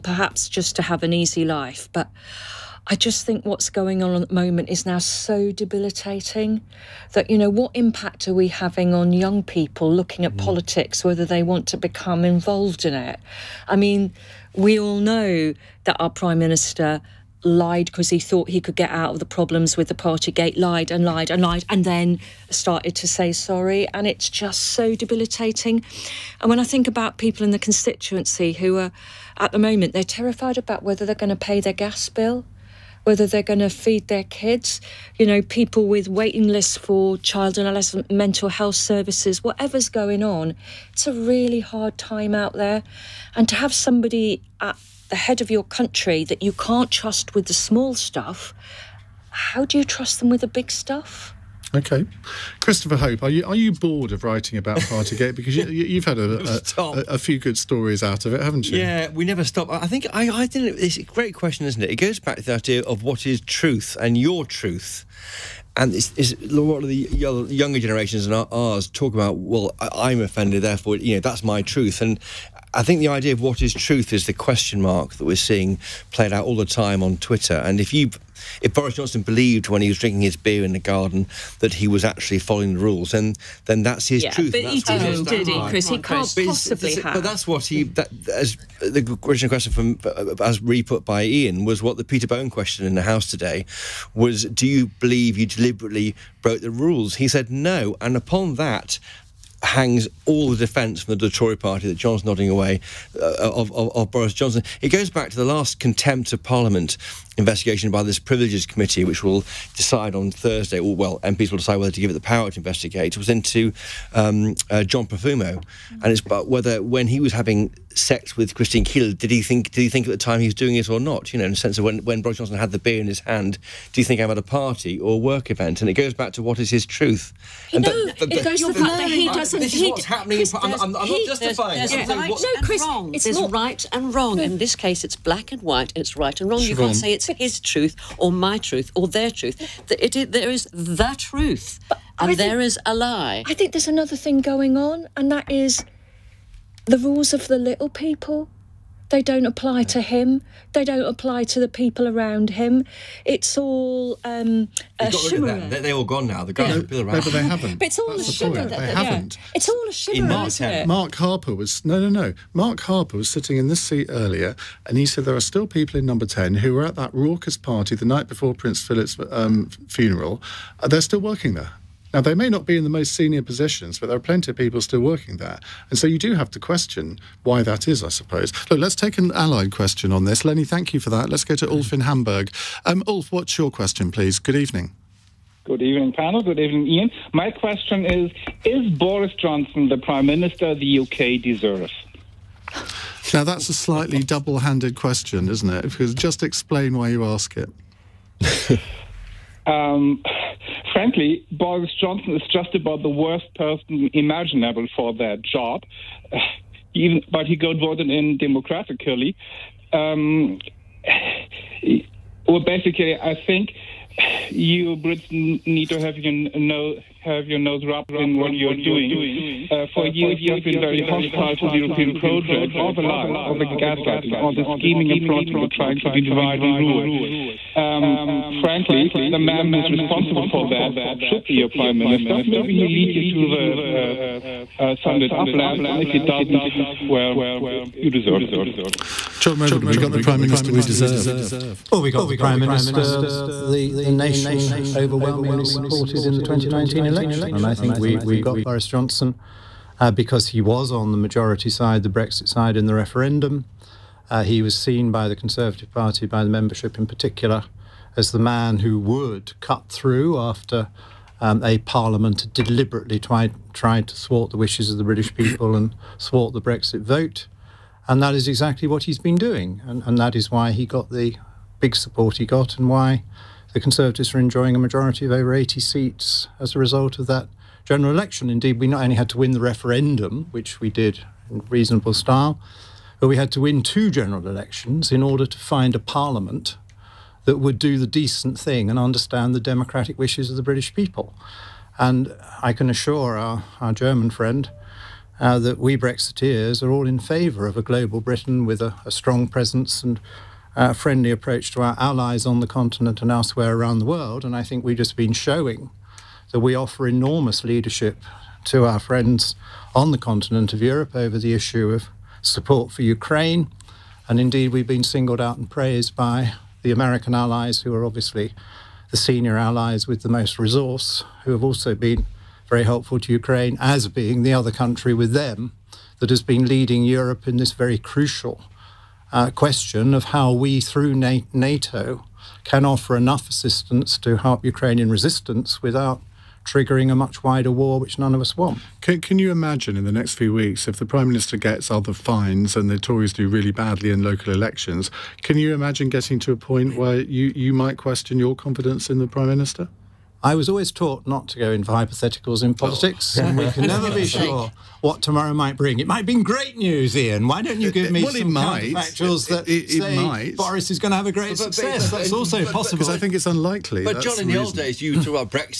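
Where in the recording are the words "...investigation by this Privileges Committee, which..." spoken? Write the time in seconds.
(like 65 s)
107 s.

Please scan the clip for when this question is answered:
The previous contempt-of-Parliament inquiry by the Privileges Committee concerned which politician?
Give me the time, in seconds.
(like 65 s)
114 s.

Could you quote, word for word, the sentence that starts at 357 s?
Why don't you give me well, some factuals that it, it, say might.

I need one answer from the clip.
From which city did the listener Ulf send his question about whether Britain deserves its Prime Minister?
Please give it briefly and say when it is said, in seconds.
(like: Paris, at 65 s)
Hamburg, at 182 s.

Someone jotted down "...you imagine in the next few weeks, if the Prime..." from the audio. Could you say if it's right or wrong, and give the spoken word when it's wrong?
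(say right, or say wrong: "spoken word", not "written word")
right.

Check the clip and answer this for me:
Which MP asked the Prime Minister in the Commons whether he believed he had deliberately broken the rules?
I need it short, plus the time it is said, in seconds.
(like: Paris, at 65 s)
Peter Bone, at 92 s.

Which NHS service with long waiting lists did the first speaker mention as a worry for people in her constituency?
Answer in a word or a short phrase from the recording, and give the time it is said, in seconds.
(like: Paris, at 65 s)
Child and adolescent mental health services, at 37 s.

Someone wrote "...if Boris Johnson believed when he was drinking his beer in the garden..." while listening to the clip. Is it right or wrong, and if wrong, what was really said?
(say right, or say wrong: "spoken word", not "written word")
right.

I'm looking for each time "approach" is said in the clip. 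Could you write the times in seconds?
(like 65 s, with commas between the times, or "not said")
301 s.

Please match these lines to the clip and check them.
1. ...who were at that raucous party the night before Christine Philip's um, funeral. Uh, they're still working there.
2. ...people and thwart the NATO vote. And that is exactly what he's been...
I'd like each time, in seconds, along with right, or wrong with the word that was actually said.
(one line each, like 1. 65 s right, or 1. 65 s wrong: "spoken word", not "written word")
1. 166 s wrong: "Prince", not "Christine"
2. 265 s wrong: "Brexit", not "NATO".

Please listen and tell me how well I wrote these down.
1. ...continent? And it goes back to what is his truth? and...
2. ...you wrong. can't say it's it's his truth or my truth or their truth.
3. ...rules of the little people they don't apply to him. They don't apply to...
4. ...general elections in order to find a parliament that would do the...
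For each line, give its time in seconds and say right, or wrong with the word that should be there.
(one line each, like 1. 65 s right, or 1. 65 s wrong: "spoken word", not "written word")
1. 125 s wrong: "event", not "continent"
2. 136 s right
3. 146 s right
4. 284 s right.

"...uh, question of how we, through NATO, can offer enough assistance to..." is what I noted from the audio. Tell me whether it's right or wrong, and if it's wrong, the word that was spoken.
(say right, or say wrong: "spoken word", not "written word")
right.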